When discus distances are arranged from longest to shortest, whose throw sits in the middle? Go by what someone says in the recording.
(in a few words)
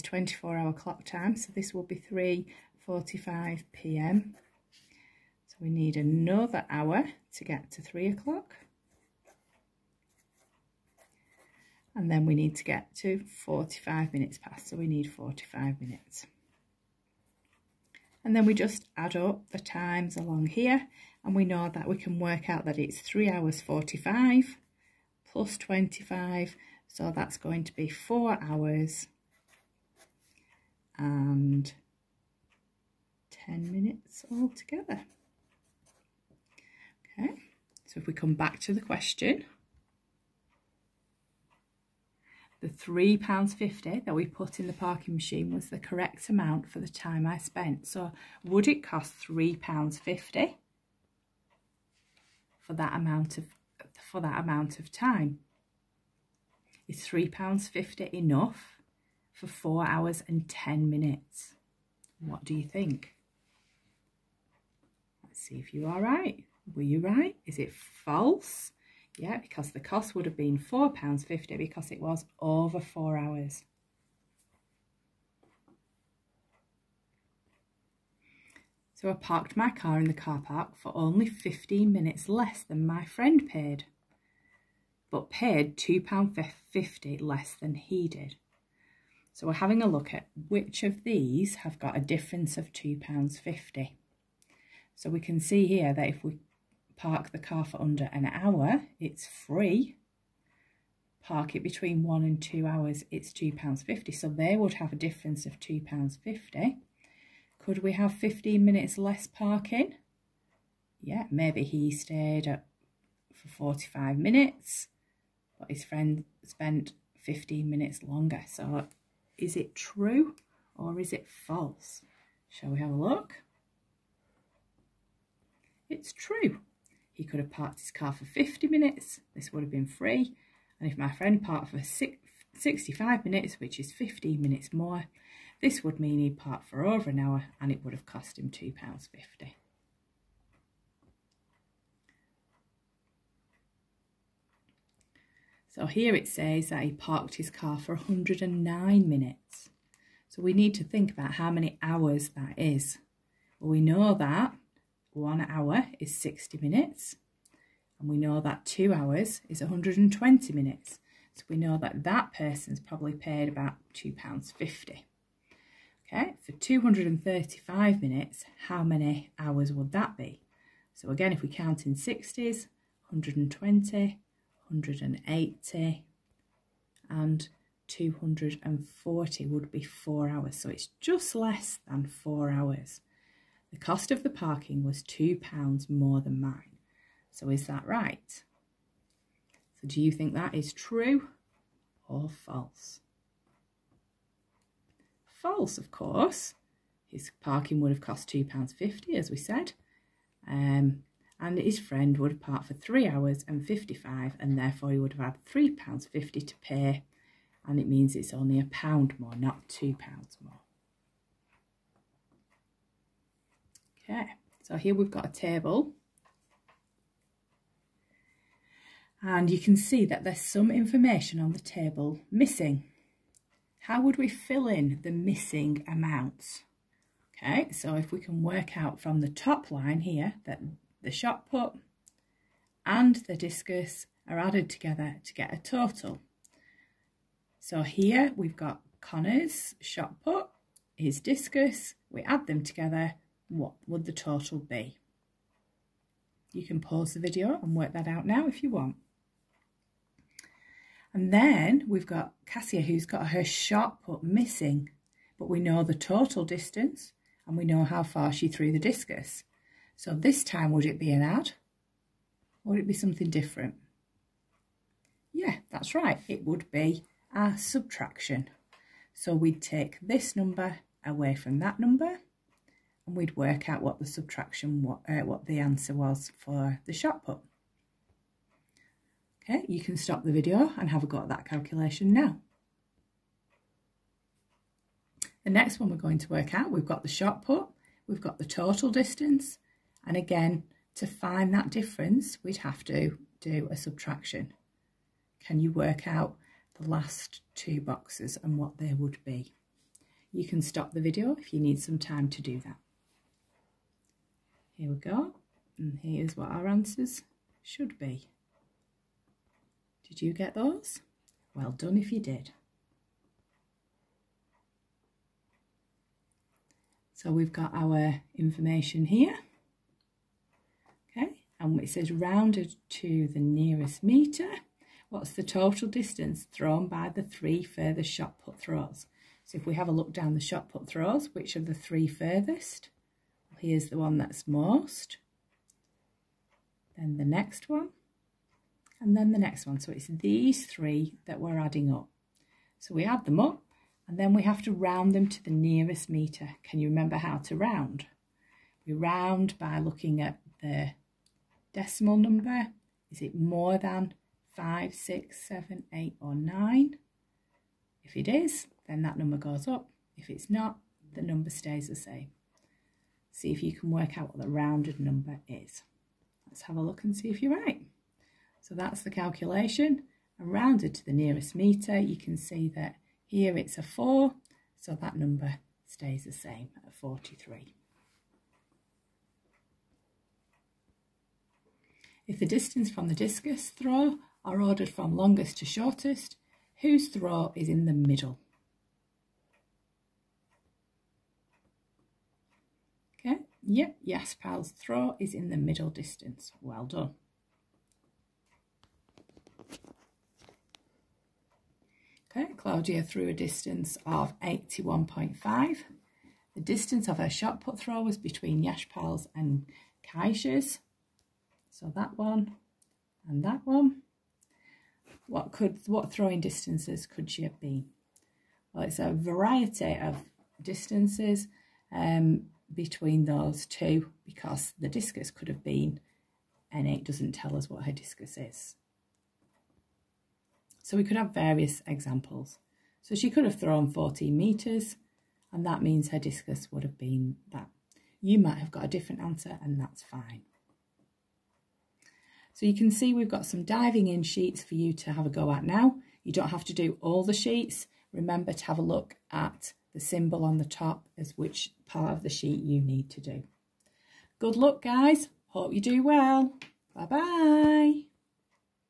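Jaspal.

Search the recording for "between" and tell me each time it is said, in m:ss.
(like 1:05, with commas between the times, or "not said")
1:41, 6:48, 7:02.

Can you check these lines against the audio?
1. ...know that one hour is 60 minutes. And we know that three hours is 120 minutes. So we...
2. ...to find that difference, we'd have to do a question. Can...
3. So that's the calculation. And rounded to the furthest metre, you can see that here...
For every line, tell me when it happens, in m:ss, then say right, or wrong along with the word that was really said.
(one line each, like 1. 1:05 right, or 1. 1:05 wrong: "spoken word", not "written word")
1. 2:33 wrong: "two", not "three"
2. 4:50 wrong: "subtraction", not "question"
3. 6:08 wrong: "nearest", not "furthest".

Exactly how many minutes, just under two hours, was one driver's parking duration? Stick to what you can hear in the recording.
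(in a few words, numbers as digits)
109 minutes.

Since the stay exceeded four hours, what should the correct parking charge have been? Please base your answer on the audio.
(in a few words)
£4.50.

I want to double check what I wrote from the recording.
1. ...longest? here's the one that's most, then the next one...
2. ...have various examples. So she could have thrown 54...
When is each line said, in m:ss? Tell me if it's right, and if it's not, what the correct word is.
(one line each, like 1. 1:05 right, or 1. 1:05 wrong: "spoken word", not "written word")
1. 5:32 wrong: "furthest", not "longest"
2. 7:11 wrong: "14", not "54".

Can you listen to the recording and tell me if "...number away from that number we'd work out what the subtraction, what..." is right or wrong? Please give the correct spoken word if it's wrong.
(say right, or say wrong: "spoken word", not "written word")
right.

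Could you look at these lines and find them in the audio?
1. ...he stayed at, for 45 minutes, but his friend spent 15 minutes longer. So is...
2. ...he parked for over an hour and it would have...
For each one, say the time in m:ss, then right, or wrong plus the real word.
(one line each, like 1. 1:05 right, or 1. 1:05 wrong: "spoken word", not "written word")
1. 1:51 right
2. 2:16 right.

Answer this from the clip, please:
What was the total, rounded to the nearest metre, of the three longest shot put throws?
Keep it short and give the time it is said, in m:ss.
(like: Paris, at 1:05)
43, at 6:16.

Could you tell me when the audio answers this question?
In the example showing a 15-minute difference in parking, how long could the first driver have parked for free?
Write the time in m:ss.
2:08.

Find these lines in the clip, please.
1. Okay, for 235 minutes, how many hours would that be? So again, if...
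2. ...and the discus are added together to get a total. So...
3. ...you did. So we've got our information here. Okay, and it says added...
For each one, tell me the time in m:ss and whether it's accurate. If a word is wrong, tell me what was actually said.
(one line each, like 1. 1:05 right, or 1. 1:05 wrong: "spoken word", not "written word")
1. 2:46 right
2. 3:52 right
3. 5:12 wrong: "rounded", not "added".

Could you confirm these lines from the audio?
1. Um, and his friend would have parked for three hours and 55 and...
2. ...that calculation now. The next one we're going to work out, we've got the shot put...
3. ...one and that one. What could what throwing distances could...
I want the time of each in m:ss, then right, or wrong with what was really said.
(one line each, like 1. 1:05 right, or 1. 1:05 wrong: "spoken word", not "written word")
1. 3:20 right
2. 4:41 right
3. 6:52 right.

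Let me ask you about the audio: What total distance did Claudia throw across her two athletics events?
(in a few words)
81.5.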